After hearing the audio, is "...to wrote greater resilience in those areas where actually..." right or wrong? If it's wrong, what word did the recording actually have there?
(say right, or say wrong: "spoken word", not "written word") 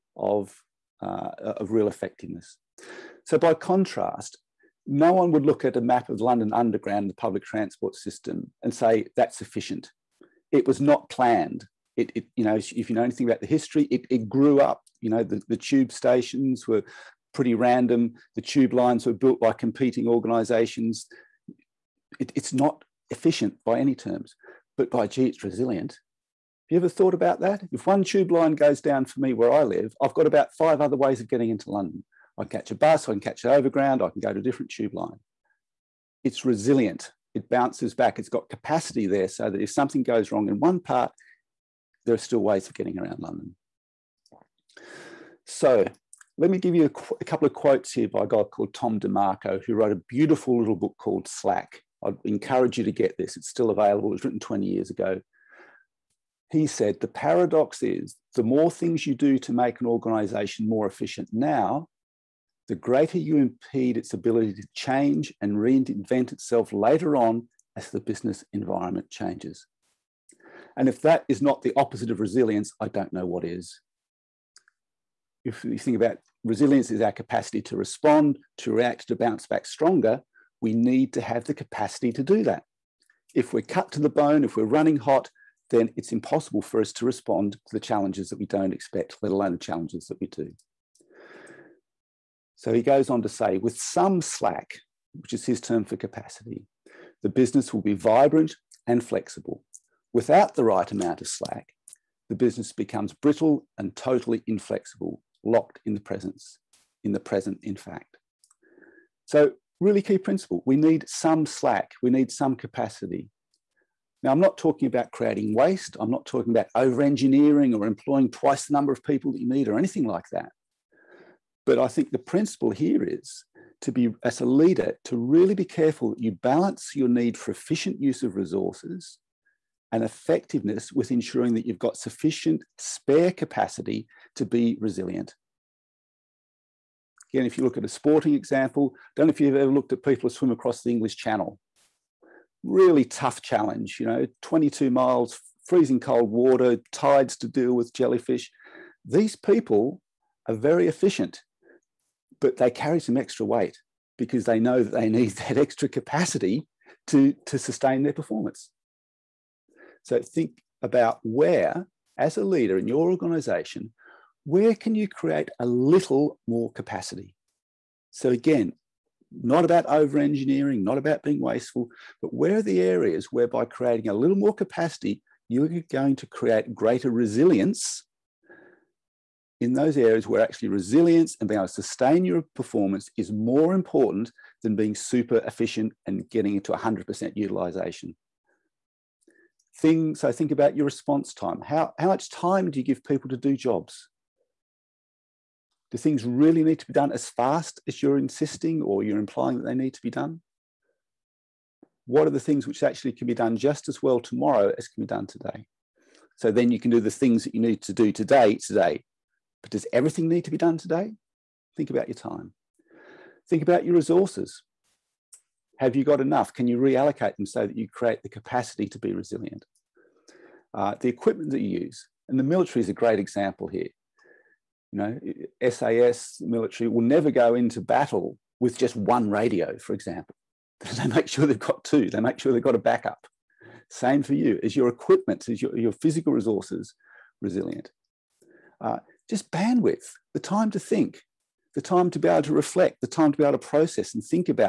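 wrong: "create", not "wrote".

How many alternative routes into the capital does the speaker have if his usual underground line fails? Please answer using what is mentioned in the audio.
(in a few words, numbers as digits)
5.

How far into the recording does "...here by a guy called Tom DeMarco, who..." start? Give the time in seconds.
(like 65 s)
47 s.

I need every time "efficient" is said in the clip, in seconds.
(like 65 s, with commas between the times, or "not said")
9 s, 23 s, 60 s, 127 s, 150 s, 185 s.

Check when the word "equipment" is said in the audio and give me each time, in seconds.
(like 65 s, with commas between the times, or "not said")
221 s, 234 s.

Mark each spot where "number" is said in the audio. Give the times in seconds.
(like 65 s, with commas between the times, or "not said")
118 s.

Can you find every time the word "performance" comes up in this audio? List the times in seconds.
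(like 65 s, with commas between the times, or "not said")
158 s, 182 s.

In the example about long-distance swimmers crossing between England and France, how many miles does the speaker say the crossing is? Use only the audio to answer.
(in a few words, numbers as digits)
22.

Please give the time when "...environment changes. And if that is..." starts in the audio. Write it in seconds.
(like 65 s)
68 s.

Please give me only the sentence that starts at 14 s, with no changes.
You know, the, the tube stations were pretty random.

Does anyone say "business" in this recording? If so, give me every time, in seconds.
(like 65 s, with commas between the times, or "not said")
67 s, 97 s, 102 s.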